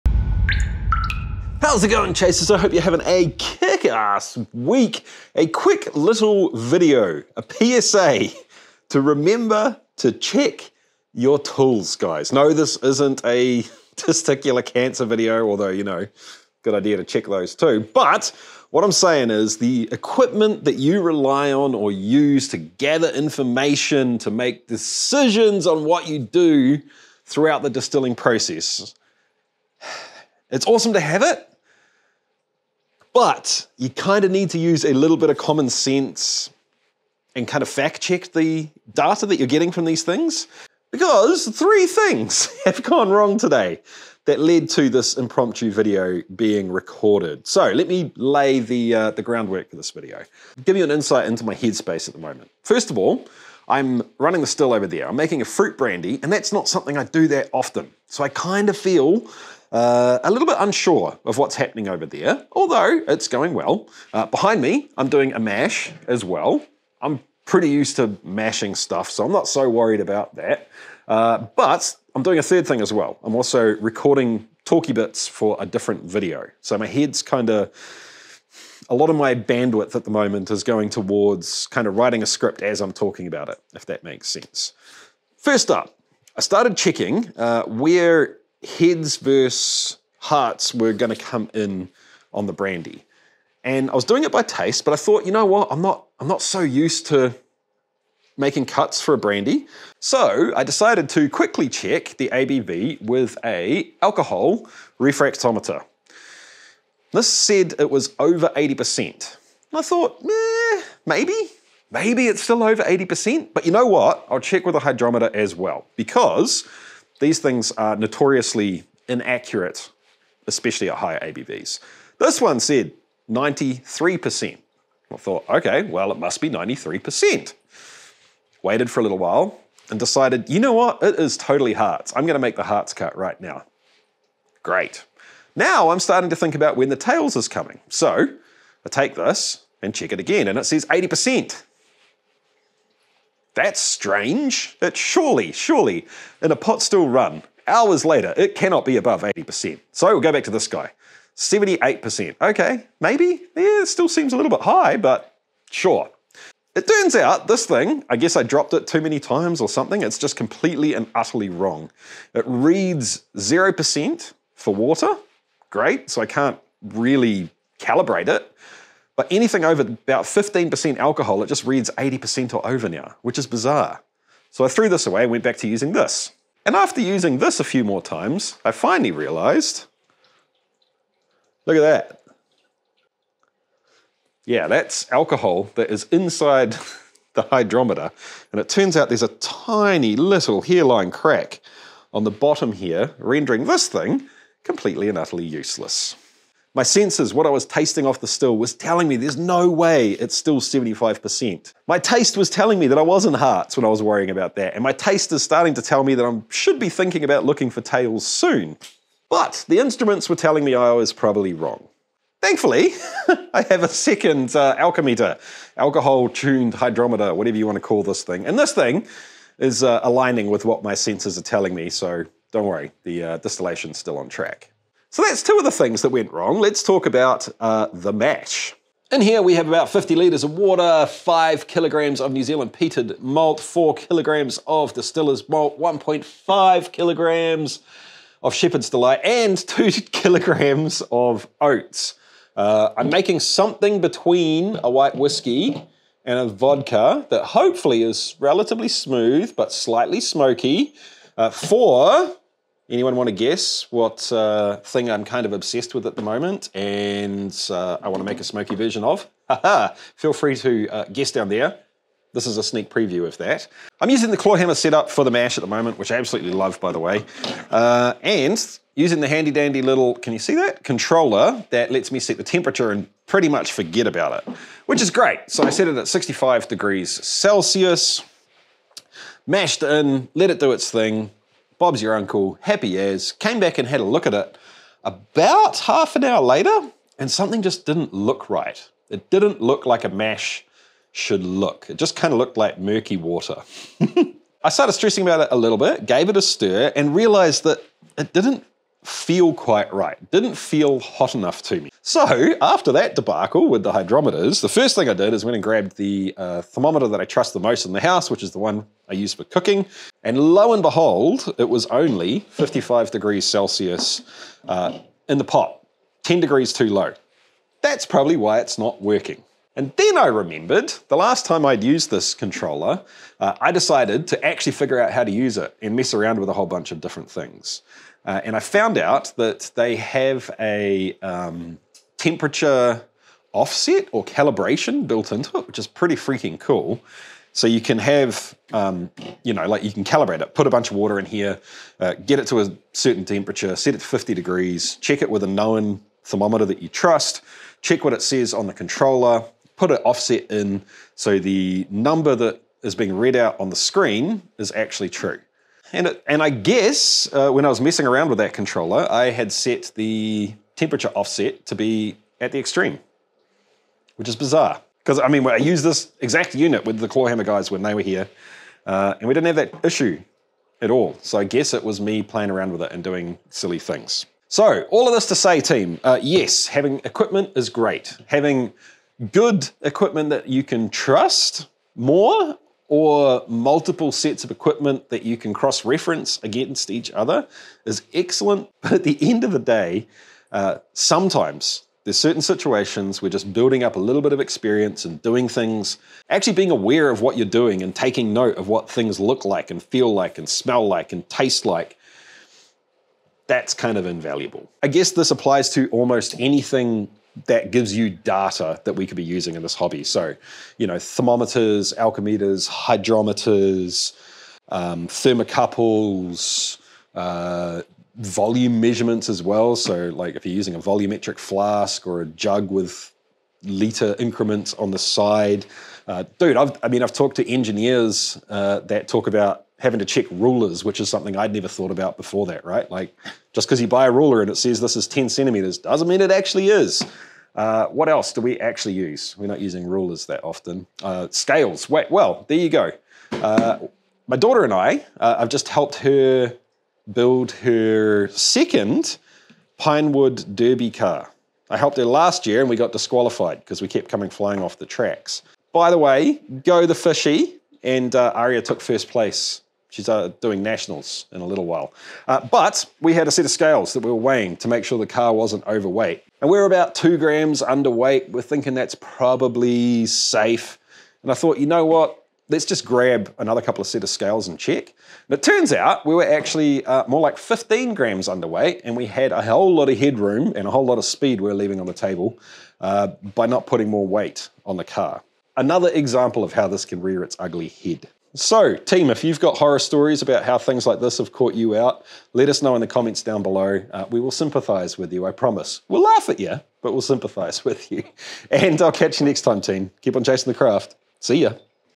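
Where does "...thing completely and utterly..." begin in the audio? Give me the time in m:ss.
3:13.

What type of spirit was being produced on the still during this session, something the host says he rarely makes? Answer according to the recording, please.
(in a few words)
fruit brandy.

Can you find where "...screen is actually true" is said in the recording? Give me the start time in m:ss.
5:53.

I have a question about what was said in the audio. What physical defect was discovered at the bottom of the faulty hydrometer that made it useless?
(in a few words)
hairline crack.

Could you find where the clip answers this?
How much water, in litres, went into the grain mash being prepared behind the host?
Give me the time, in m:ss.
3:49.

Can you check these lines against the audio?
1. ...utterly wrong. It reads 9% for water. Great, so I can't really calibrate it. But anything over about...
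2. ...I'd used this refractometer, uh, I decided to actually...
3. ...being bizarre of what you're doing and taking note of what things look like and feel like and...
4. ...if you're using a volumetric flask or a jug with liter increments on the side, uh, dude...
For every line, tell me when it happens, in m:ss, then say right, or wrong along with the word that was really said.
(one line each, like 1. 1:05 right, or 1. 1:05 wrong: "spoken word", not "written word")
1. 2:41 wrong: "0", not "9"
2. 5:21 wrong: "controller", not "refractometer"
3. 6:36 wrong: "aware", not "bizarre"
4. 7:00 right.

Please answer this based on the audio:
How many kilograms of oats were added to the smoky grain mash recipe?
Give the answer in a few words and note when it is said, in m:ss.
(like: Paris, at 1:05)
2 kilograms, at 3:59.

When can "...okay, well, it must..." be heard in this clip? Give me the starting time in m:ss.
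2:05.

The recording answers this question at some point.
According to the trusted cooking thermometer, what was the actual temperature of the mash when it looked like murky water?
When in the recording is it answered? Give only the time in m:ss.
5:12.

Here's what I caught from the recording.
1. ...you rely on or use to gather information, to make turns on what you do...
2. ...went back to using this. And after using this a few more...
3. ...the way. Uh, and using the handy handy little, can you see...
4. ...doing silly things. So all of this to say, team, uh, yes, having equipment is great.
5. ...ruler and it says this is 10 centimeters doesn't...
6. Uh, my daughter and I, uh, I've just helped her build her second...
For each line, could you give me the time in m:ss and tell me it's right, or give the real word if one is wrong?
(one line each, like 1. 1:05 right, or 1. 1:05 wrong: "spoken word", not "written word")
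1. 0:20 wrong: "decisions", not "turns"
2. 2:55 right
3. 4:26 wrong: "dandy", not "handy"
4. 6:13 right
5. 7:14 right
6. 7:23 right.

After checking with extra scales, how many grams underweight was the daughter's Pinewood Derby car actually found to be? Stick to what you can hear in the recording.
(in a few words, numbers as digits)
15 grams.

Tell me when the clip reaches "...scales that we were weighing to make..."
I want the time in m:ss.
7:43.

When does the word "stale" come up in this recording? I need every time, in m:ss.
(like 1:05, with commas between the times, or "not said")
not said.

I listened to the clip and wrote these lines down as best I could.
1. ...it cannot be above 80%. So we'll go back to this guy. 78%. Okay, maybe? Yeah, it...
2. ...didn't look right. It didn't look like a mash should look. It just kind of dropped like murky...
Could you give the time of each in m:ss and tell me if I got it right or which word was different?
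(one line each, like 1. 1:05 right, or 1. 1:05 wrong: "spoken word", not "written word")
1. 2:28 right
2. 4:47 wrong: "looked", not "dropped".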